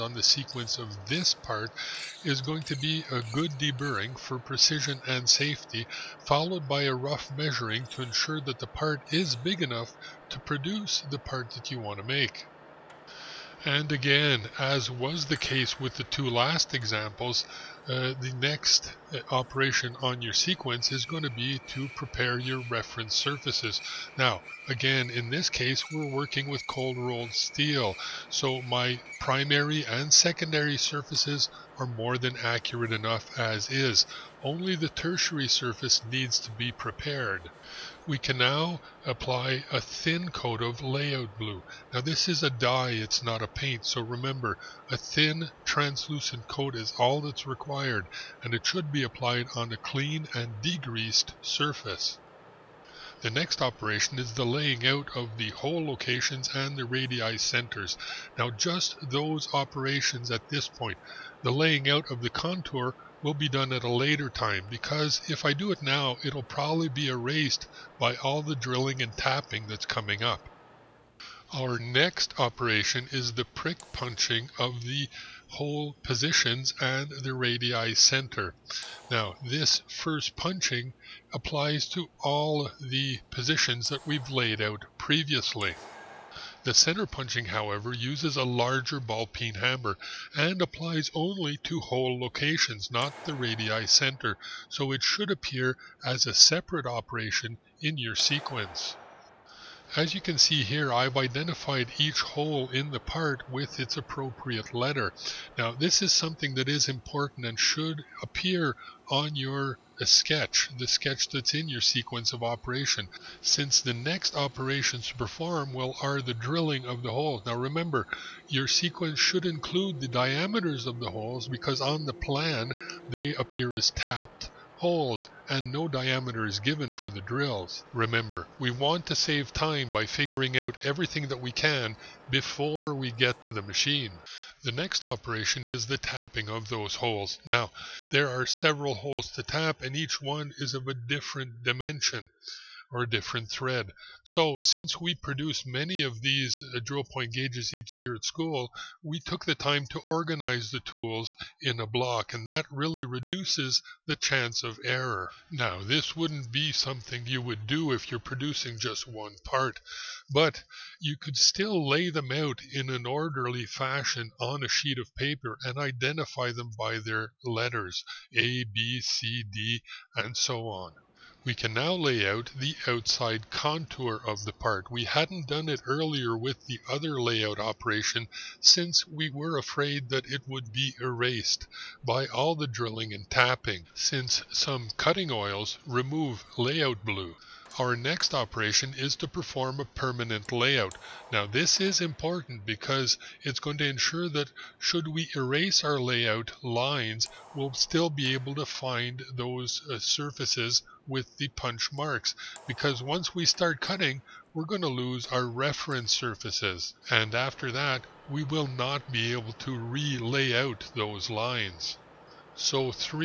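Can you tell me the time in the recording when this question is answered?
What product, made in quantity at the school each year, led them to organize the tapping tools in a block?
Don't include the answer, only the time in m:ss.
2:26.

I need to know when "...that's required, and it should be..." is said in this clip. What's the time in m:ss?
0:47.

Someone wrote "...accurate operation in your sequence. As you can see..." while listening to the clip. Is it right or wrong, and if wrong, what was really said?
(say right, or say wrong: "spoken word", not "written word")
wrong: "separate", not "accurate".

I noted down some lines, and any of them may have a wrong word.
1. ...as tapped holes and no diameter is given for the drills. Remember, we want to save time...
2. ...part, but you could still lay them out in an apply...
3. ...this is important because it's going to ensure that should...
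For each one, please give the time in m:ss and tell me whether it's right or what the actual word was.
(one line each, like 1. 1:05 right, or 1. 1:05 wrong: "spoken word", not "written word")
1. 2:03 right
2. 2:39 wrong: "orderly", not "apply"
3. 3:11 right.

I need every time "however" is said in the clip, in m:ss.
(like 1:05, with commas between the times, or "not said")
1:27.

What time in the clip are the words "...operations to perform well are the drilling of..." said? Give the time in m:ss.
1:54.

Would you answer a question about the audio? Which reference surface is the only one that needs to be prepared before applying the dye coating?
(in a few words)
The tertiary surface.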